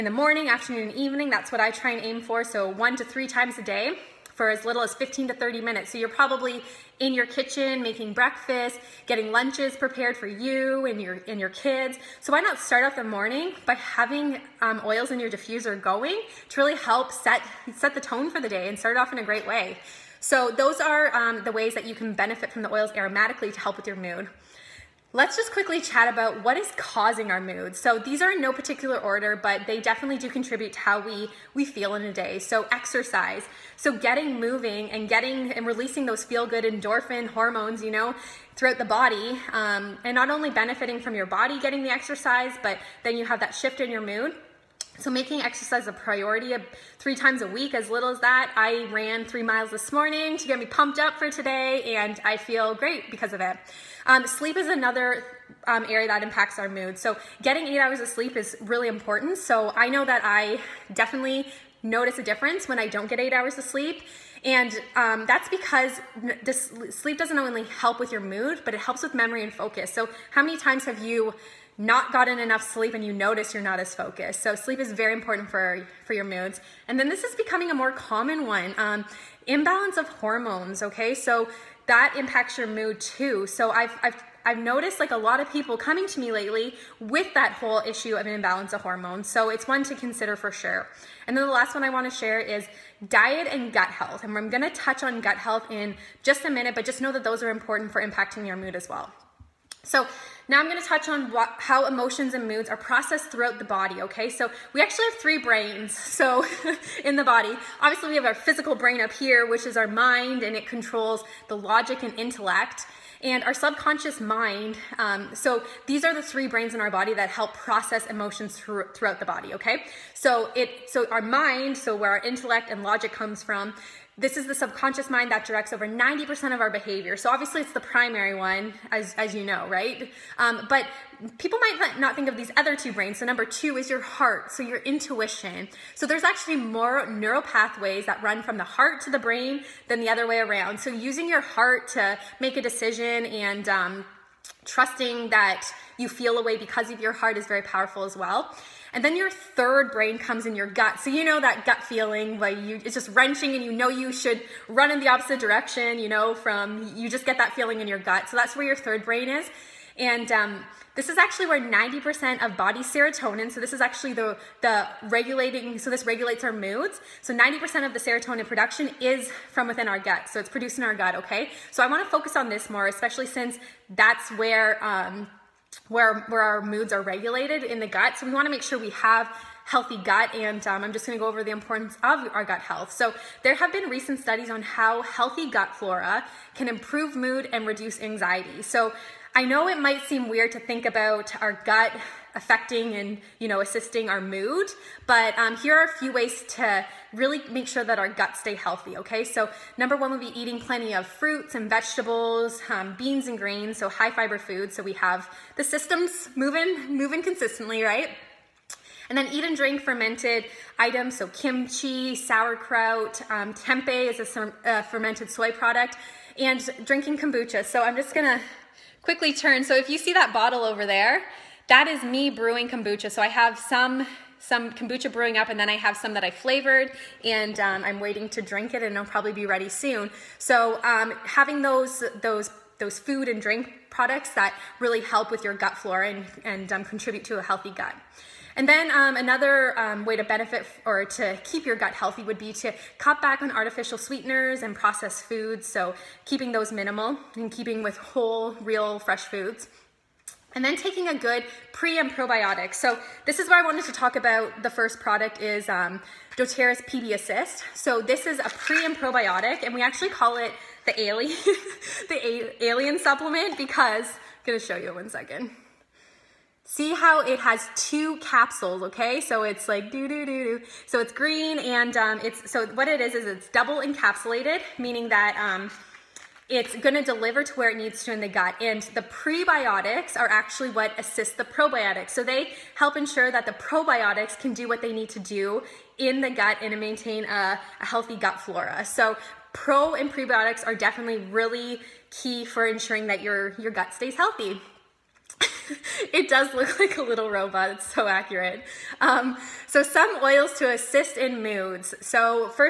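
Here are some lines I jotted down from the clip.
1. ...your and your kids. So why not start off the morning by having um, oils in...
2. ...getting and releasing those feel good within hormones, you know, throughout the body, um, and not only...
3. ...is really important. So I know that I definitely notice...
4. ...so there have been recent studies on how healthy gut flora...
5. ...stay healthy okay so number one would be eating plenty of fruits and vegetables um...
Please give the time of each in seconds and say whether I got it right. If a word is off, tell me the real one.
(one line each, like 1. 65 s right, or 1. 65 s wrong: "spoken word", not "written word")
1. 10 s right
2. 35 s wrong: "endorphin", not "within"
3. 58 s right
4. 182 s right
5. 198 s right.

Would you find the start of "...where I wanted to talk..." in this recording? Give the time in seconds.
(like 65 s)
253 s.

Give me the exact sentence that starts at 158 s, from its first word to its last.
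So that's where your third brain is.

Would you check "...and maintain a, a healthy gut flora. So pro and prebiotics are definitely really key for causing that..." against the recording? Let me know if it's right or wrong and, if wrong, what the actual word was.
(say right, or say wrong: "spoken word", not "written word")
wrong: "ensuring", not "causing".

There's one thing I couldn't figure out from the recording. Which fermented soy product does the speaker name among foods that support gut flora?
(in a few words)
tempeh.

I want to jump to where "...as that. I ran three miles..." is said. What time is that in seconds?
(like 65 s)
48 s.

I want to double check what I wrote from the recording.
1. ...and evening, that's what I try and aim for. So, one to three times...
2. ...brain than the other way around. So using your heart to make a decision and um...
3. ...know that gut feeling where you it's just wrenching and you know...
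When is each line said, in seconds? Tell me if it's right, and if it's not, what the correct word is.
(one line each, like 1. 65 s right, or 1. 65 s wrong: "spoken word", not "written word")
1. 0 s right
2. 139 s right
3. 151 s right.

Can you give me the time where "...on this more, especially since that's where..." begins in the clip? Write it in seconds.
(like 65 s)
172 s.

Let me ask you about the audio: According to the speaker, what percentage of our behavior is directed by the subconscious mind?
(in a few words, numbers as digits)
90%.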